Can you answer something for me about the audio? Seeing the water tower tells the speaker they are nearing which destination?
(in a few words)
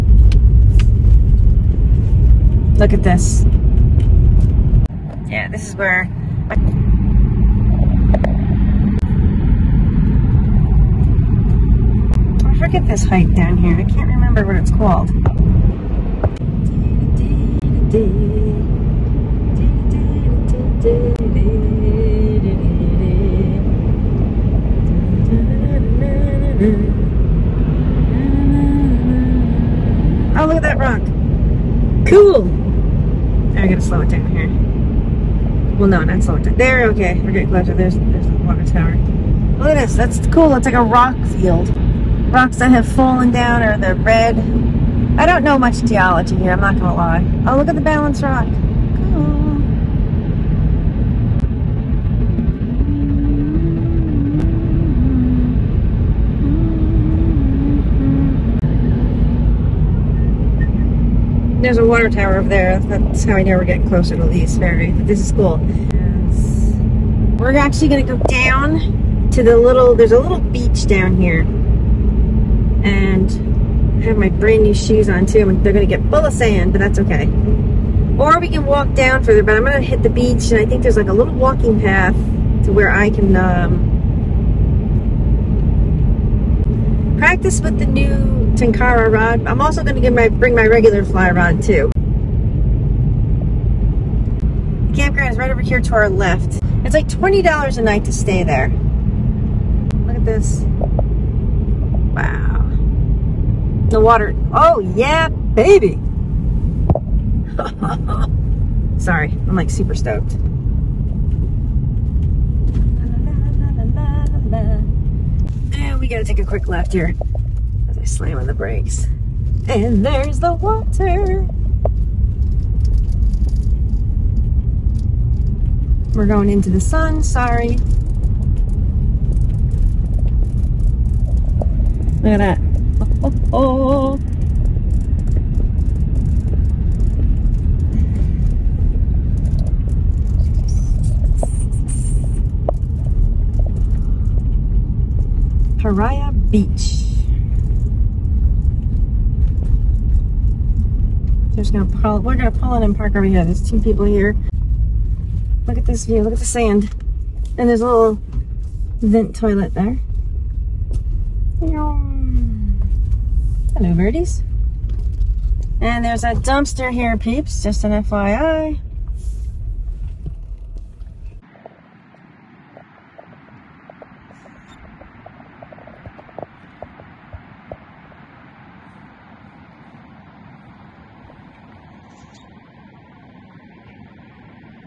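Lee's Ferry.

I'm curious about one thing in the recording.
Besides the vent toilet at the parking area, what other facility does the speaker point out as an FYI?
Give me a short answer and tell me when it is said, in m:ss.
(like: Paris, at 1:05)
a dumpster, at 2:46.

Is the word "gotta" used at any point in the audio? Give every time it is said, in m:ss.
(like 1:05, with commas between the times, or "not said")
0:33, 1:56.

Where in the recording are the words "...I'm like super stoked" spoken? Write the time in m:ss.
1:49.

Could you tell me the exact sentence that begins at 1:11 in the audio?
And I have my brand new shoes on too.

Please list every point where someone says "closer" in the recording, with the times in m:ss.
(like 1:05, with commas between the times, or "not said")
0:37, 1:03.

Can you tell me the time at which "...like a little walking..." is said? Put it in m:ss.
1:20.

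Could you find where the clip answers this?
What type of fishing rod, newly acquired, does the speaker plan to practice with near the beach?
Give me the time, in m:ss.
1:28.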